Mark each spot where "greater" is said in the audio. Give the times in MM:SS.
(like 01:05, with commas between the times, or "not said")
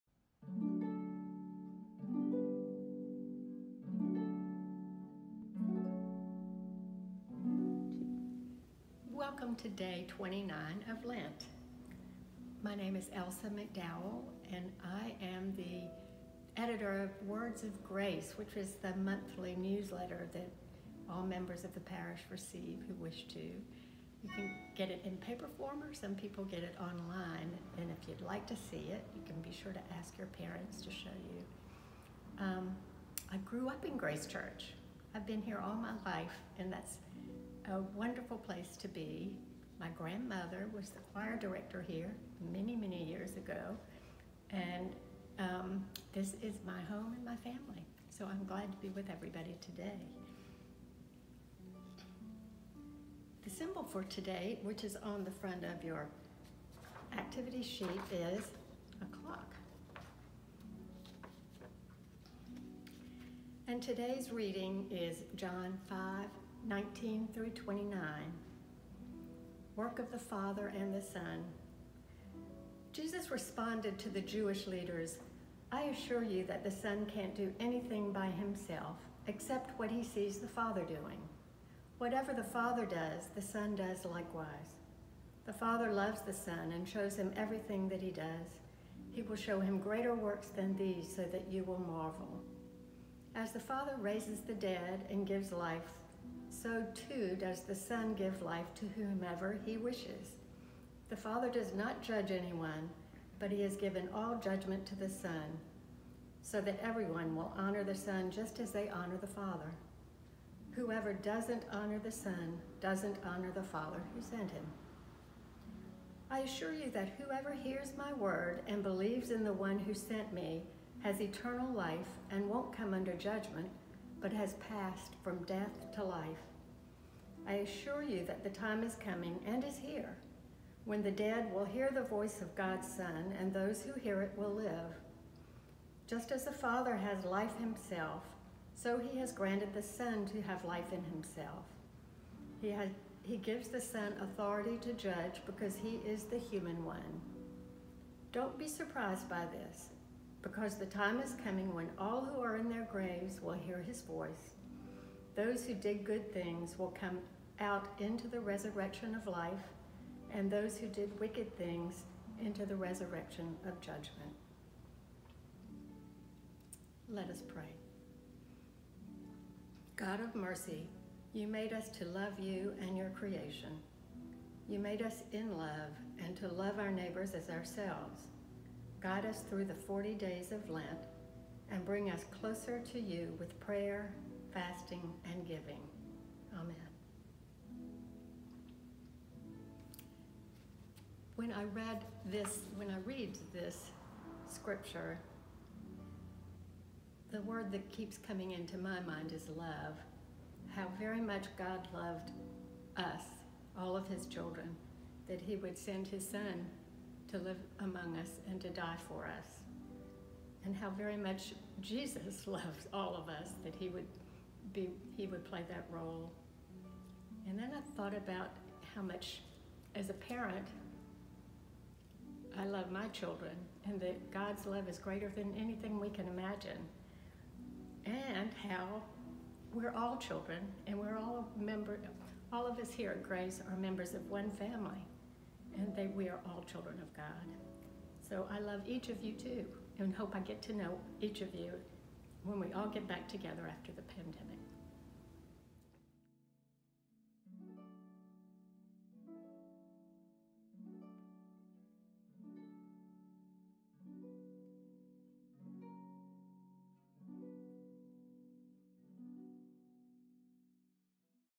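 01:29, 03:44.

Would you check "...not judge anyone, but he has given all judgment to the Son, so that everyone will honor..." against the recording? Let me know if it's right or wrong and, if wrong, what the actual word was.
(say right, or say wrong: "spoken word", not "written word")
right.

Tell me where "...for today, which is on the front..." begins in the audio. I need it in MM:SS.
00:53.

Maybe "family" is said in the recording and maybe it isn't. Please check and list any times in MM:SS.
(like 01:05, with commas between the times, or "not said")
00:47, 03:54.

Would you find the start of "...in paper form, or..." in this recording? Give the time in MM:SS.
00:25.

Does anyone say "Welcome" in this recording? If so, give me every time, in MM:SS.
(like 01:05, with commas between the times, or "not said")
00:09.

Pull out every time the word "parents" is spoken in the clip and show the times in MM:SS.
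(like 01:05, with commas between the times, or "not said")
00:30, 03:40.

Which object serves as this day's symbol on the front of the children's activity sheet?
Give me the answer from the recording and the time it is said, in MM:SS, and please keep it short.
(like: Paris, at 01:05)
A clock, at 00:59.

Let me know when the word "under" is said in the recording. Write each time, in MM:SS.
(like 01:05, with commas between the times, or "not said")
02:02.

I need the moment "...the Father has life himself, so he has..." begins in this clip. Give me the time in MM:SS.
02:16.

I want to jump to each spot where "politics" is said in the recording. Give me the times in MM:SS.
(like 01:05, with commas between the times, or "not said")
not said.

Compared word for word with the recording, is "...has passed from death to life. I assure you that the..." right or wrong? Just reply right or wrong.
right.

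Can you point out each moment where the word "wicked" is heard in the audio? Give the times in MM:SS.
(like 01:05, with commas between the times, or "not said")
02:41.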